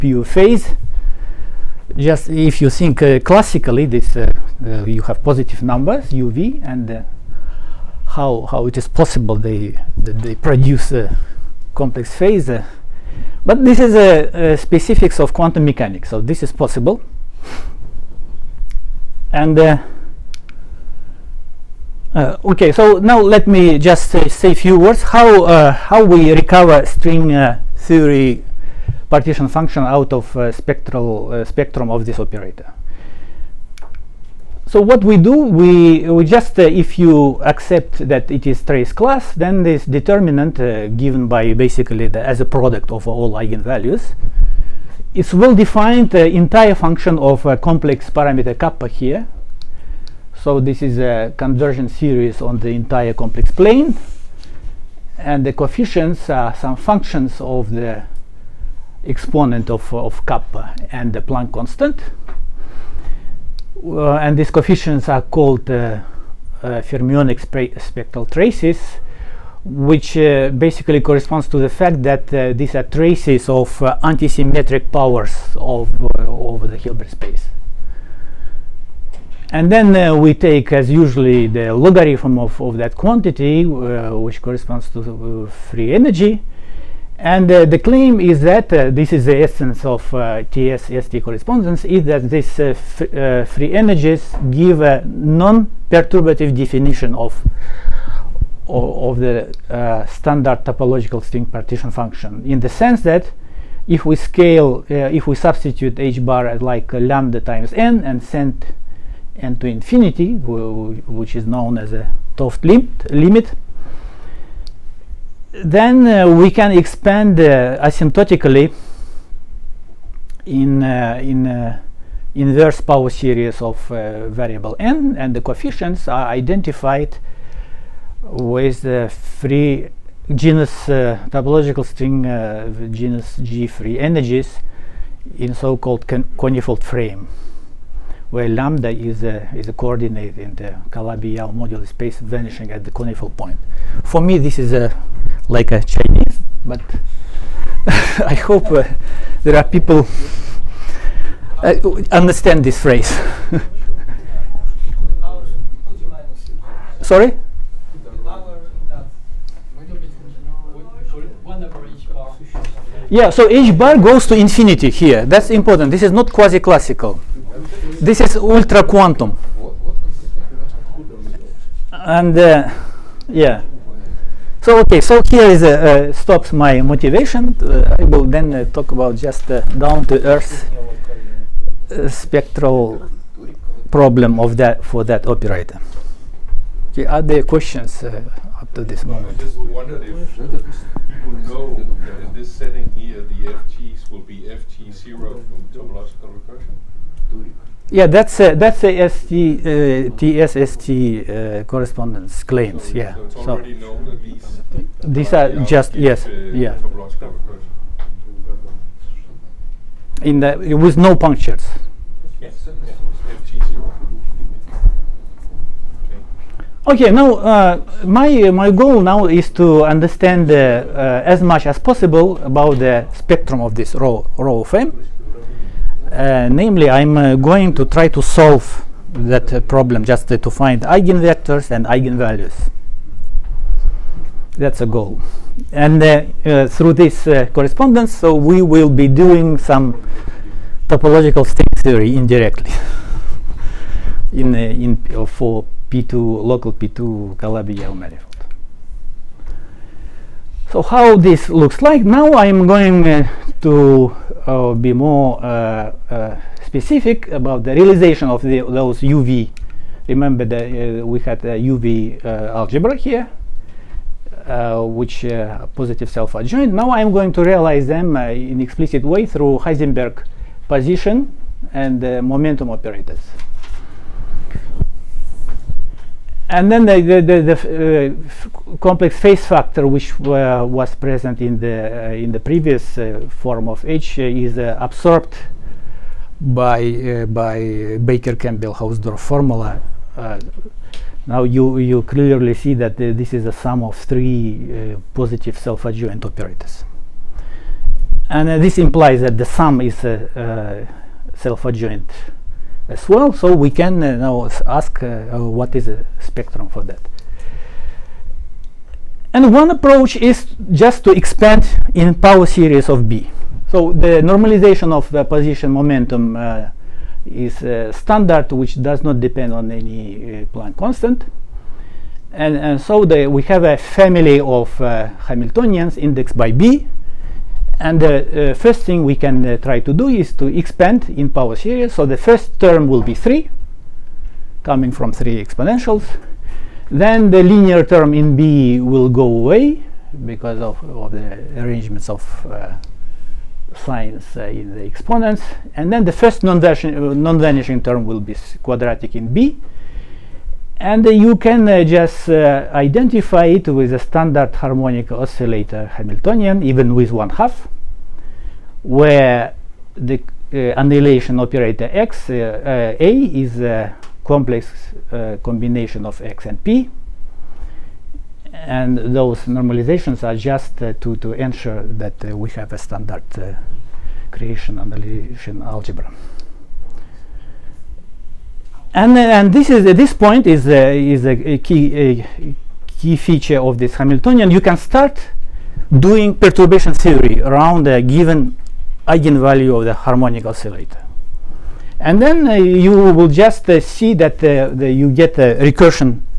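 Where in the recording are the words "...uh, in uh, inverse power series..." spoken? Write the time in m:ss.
2:00.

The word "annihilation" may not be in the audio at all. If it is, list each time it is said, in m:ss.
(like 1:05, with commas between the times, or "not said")
6:00, 6:14.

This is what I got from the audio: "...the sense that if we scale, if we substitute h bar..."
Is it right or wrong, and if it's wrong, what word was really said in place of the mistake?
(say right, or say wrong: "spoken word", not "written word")
right.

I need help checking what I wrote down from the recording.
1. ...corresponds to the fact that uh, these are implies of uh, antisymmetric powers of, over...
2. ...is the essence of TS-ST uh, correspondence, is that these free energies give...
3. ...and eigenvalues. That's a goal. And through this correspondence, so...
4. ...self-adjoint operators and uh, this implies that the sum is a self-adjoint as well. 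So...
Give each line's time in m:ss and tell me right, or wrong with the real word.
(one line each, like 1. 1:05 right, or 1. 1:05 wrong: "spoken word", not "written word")
1. 1:10 wrong: "traces", not "implies"
2. 1:29 right
3. 3:51 right
4. 4:55 right.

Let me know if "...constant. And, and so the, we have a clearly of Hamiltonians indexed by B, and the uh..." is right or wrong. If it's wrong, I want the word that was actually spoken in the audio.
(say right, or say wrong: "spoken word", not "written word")
wrong: "family", not "clearly".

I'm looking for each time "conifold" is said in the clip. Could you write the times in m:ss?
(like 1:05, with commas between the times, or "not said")
2:16, 2:22.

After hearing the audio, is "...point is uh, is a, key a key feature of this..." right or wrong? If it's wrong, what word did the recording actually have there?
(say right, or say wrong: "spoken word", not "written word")
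right.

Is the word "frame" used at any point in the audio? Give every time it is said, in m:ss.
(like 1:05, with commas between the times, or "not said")
2:16, 3:44.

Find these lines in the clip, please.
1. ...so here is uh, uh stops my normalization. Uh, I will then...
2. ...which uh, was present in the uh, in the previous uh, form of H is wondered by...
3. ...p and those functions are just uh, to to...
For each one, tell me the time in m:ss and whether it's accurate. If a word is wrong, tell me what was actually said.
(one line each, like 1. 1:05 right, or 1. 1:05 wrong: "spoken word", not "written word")
1. 2:54 wrong: "motivation", not "normalization"
2. 4:39 wrong: "absorbed", not "wondered"
3. 6:06 wrong: "normalizations", not "functions".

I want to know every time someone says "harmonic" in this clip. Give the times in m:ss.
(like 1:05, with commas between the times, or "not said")
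5:54, 6:29.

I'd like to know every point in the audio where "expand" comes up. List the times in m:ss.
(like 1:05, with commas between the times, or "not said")
1:56, 5:11, 5:30.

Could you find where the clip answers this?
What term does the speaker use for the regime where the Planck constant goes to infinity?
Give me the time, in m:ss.
2:48.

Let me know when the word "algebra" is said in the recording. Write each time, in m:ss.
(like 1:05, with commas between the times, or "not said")
4:22, 6:15.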